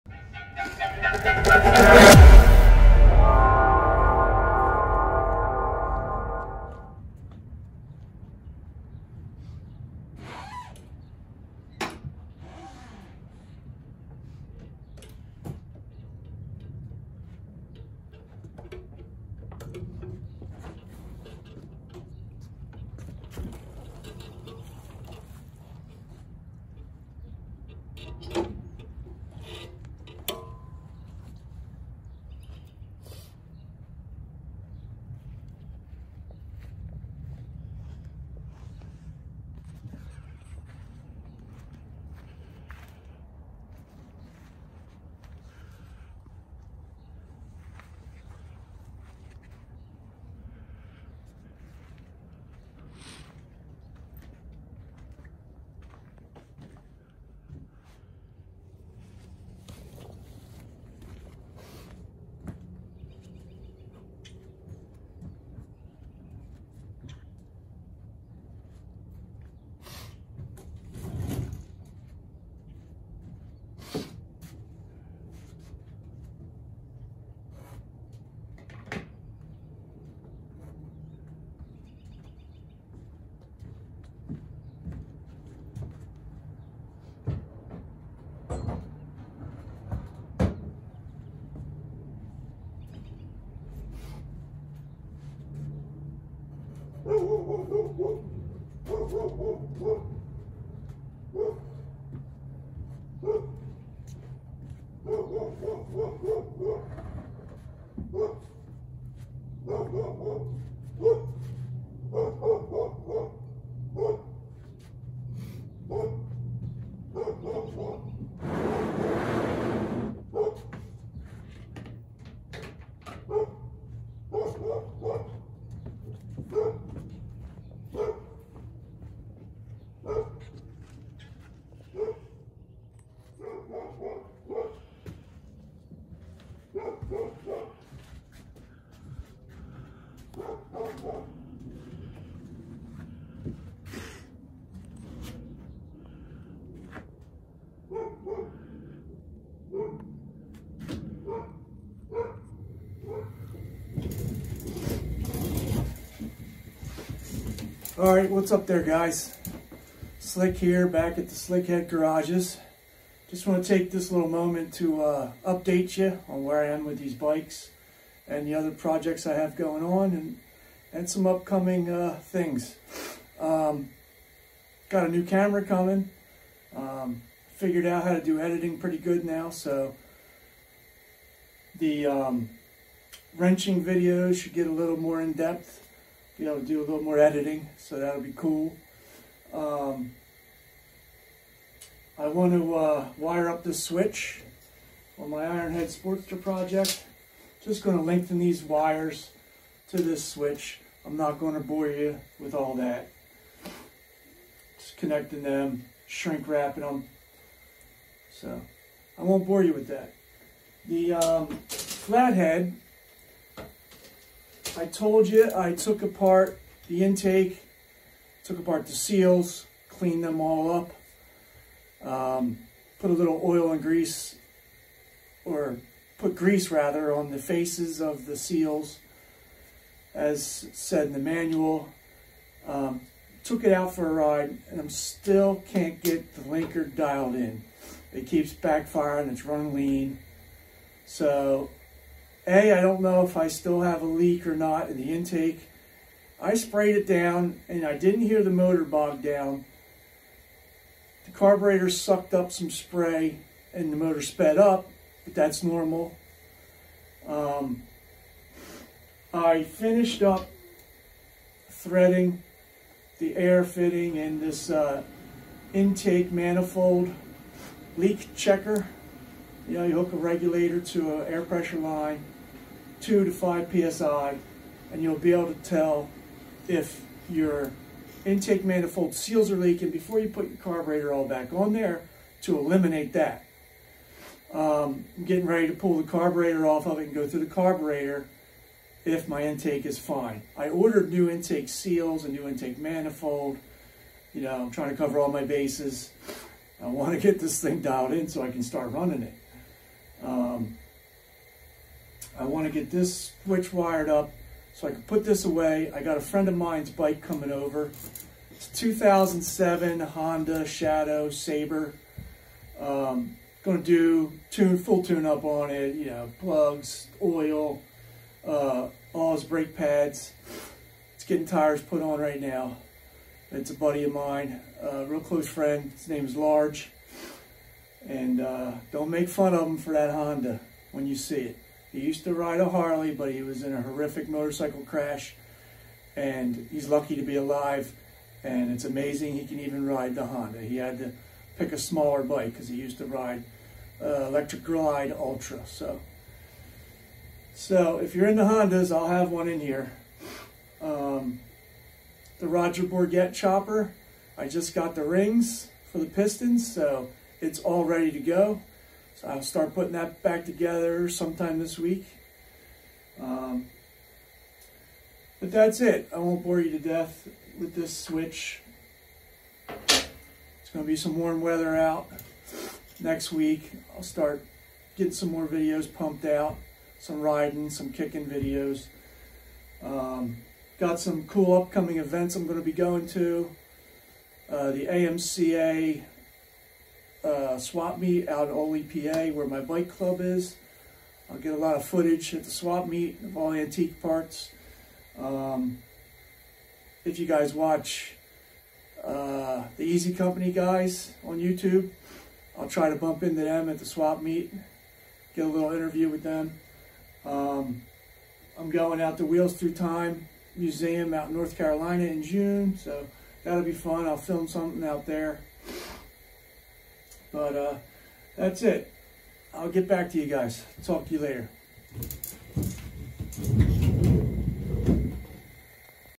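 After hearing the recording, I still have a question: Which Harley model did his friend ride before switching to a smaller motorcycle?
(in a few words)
Electric Glide Ultra.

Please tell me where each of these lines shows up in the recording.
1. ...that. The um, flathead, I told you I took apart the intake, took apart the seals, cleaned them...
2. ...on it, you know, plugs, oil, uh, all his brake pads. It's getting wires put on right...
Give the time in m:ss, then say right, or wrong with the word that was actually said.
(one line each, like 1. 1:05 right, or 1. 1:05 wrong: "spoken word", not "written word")
1. 3:29 right
2. 5:15 wrong: "tires", not "wires".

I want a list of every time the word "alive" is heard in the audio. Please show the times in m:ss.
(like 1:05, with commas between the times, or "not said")
5:37.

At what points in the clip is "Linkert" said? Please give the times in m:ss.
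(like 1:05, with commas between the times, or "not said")
3:56.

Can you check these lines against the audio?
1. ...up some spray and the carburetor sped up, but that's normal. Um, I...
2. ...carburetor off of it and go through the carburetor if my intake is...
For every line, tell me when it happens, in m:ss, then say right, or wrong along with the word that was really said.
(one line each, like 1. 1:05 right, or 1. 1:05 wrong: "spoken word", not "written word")
1. 4:12 wrong: "motor", not "carburetor"
2. 4:46 right.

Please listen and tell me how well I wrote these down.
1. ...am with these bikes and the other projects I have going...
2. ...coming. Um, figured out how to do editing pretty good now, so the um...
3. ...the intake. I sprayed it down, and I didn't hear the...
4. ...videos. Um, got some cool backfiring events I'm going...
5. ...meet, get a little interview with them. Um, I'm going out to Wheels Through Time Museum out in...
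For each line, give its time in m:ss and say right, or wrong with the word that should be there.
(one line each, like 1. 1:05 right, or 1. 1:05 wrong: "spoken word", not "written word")
1. 2:46 right
2. 2:55 right
3. 4:04 right
4. 6:18 wrong: "upcoming", not "backfiring"
5. 6:44 right.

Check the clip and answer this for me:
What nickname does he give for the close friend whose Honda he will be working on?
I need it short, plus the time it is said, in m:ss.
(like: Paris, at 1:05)
Large, at 5:26.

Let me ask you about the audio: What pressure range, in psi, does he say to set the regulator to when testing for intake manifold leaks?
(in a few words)
2 to 5 psi.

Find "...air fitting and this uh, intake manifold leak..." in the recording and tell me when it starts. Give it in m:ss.
4:23.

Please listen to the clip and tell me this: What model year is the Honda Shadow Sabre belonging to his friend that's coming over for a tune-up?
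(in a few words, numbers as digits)
2007.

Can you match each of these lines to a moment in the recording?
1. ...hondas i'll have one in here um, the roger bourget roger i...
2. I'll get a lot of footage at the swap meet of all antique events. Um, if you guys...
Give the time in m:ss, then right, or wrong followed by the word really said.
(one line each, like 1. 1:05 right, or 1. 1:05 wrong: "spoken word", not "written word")
1. 5:48 wrong: "chopper", not "roger"
2. 6:31 wrong: "parts", not "events".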